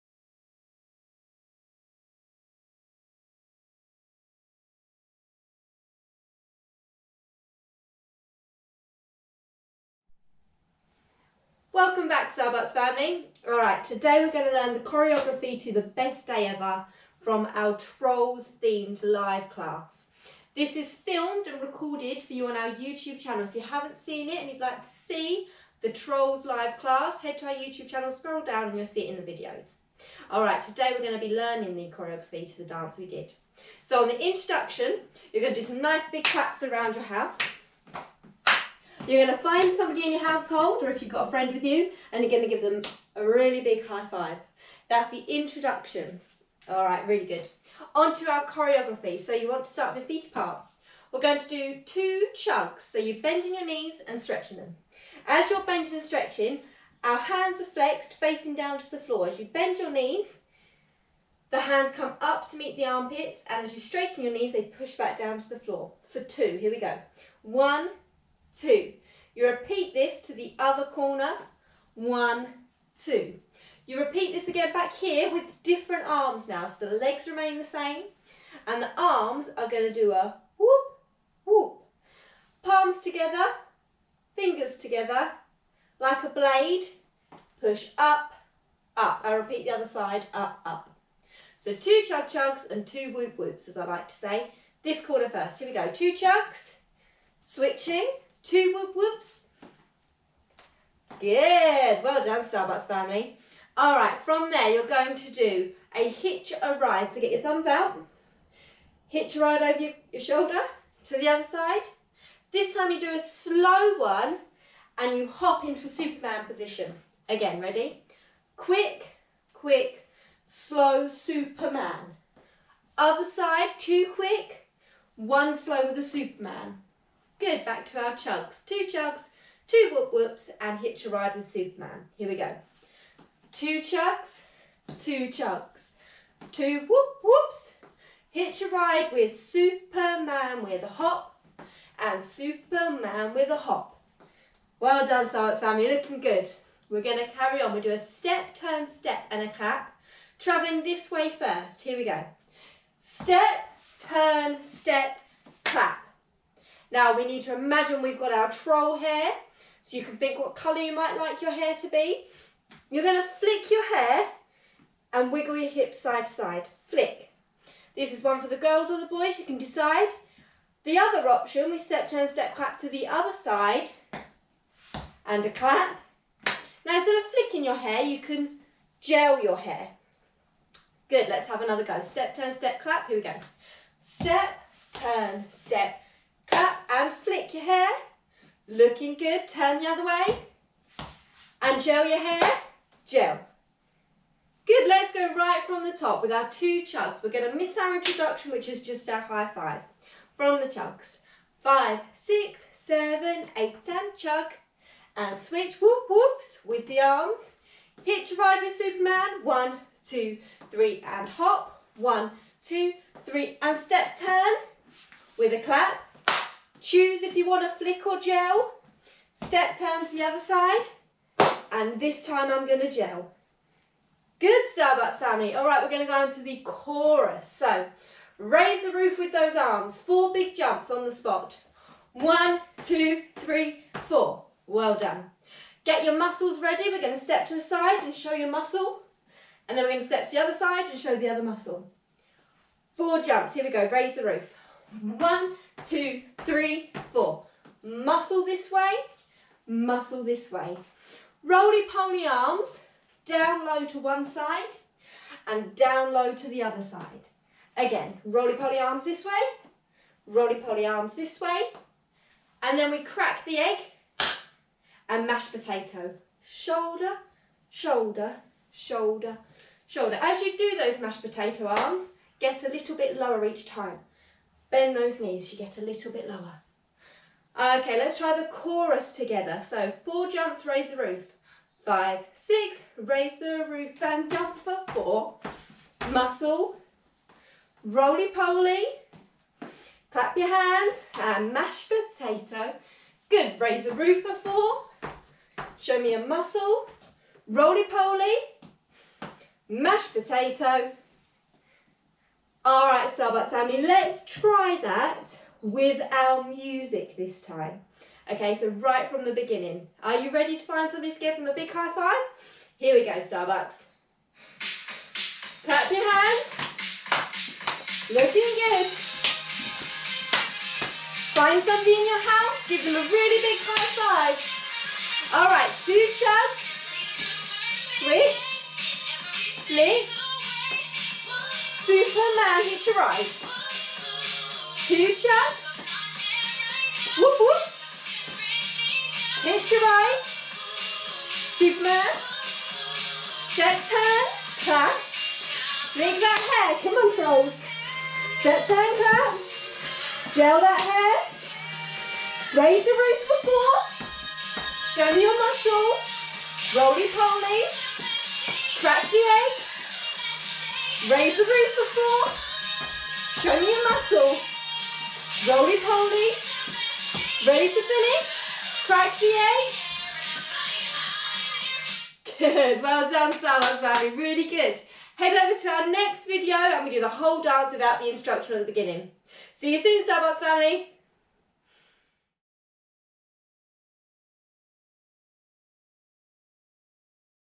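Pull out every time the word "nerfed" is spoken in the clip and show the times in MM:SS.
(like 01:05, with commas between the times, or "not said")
not said.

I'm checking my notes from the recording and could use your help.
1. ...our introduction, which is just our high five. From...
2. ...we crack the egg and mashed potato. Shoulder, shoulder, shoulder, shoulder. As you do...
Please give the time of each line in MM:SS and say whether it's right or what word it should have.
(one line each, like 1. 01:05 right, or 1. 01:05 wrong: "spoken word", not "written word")
1. 03:17 right
2. 04:22 right.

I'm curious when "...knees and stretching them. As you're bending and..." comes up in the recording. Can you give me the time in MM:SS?
00:53.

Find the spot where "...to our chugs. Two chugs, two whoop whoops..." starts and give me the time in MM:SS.
02:07.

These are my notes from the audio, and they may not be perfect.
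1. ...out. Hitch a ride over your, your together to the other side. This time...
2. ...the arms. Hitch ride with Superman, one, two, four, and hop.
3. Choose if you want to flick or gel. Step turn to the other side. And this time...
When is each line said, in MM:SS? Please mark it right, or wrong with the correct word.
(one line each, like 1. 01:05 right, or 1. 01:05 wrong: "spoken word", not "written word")
1. 01:47 wrong: "shoulder", not "together"
2. 03:26 wrong: "three", not "four"
3. 03:36 right.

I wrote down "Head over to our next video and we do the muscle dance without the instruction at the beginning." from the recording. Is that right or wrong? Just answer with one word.
wrong.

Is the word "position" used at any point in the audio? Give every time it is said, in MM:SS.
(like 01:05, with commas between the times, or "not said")
01:56.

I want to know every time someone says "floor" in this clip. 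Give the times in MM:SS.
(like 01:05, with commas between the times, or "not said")
00:58, 01:05.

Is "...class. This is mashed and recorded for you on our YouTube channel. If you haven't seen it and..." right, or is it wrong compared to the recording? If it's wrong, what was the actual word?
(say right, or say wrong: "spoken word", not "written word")
wrong: "filmed", not "mashed".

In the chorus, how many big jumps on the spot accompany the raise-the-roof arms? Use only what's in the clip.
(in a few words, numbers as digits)
4.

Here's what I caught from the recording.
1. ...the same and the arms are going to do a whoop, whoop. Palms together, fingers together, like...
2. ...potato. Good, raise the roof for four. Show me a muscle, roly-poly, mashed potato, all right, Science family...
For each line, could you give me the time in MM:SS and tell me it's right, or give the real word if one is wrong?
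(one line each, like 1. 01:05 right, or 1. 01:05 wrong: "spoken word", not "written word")
1. 01:17 right
2. 04:51 wrong: "Starbucks", not "Science".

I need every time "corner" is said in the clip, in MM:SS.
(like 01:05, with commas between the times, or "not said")
01:10, 01:35.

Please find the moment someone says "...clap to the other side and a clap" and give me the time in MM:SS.
02:52.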